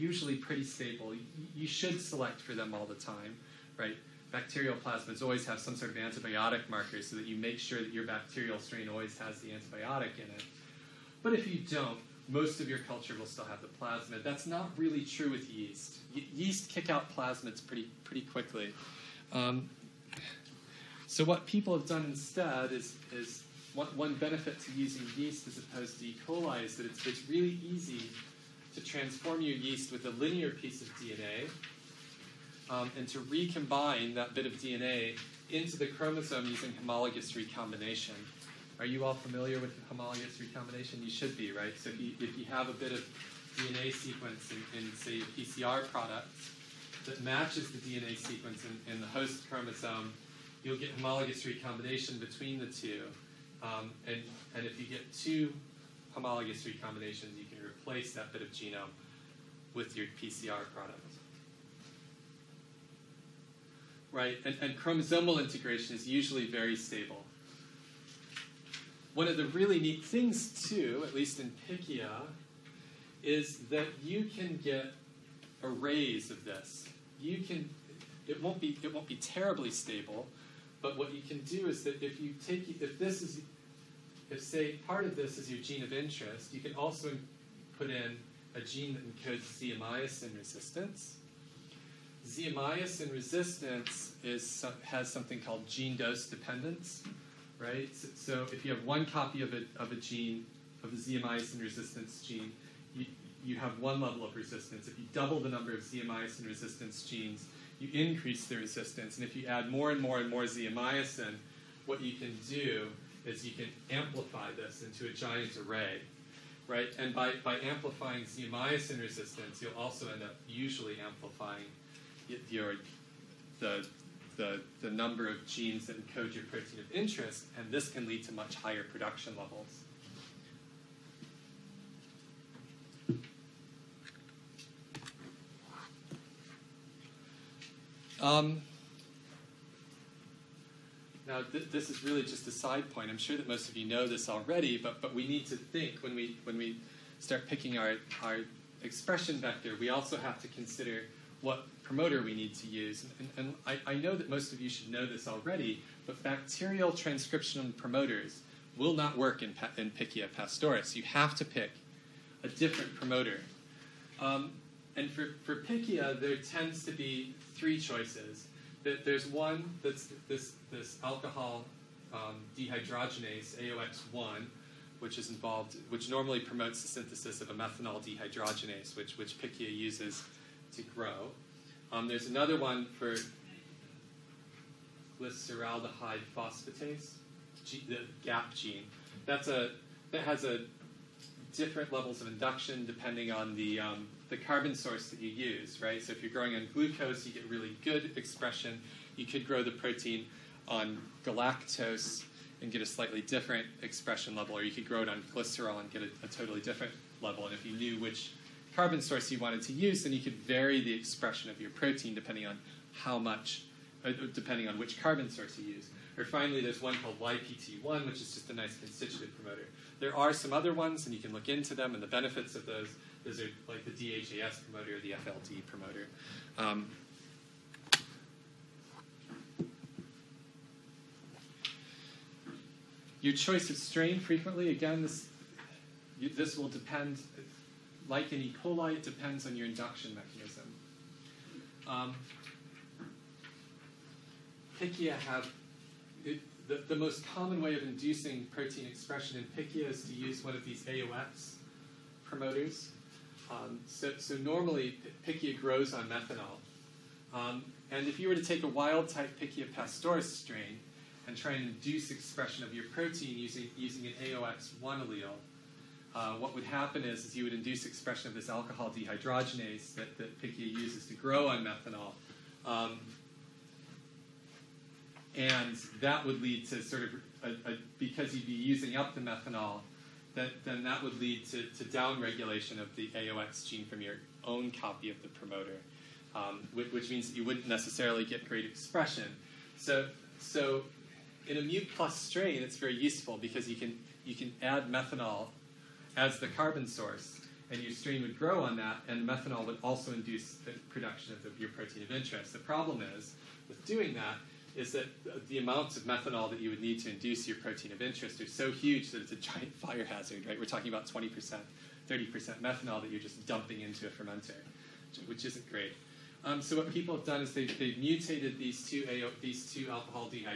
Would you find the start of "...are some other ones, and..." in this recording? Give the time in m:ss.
3:40.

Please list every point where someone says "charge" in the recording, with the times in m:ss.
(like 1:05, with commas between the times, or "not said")
not said.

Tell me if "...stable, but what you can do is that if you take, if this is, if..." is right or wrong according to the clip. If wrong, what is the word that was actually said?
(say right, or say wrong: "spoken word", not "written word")
right.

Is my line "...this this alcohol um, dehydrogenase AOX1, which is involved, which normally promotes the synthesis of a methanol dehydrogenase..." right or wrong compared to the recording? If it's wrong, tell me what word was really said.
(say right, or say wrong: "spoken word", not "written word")
right.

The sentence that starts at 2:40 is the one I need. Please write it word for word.
You have to pick a different promoter.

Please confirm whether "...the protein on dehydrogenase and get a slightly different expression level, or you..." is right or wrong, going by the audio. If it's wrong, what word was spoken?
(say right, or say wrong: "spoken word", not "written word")
wrong: "galactose", not "dehydrogenase".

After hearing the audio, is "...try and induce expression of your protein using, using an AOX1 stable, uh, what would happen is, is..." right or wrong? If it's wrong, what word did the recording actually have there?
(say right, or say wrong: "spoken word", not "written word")
wrong: "allele", not "stable".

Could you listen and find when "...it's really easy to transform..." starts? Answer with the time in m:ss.
0:27.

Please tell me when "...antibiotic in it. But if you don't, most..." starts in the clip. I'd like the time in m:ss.
0:09.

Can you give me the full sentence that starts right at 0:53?
Um, and, and if you get two homologous recombinations, you can replace that bit of genome with your PCR product.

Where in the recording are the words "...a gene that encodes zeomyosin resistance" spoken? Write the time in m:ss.
1:28.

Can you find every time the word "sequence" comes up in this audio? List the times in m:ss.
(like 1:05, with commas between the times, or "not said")
0:43, 0:48.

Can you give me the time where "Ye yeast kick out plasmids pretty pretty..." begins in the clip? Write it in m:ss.
0:16.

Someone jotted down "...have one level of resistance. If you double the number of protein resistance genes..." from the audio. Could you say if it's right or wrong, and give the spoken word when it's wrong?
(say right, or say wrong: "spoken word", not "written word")
wrong: "zeomyosin", not "protein".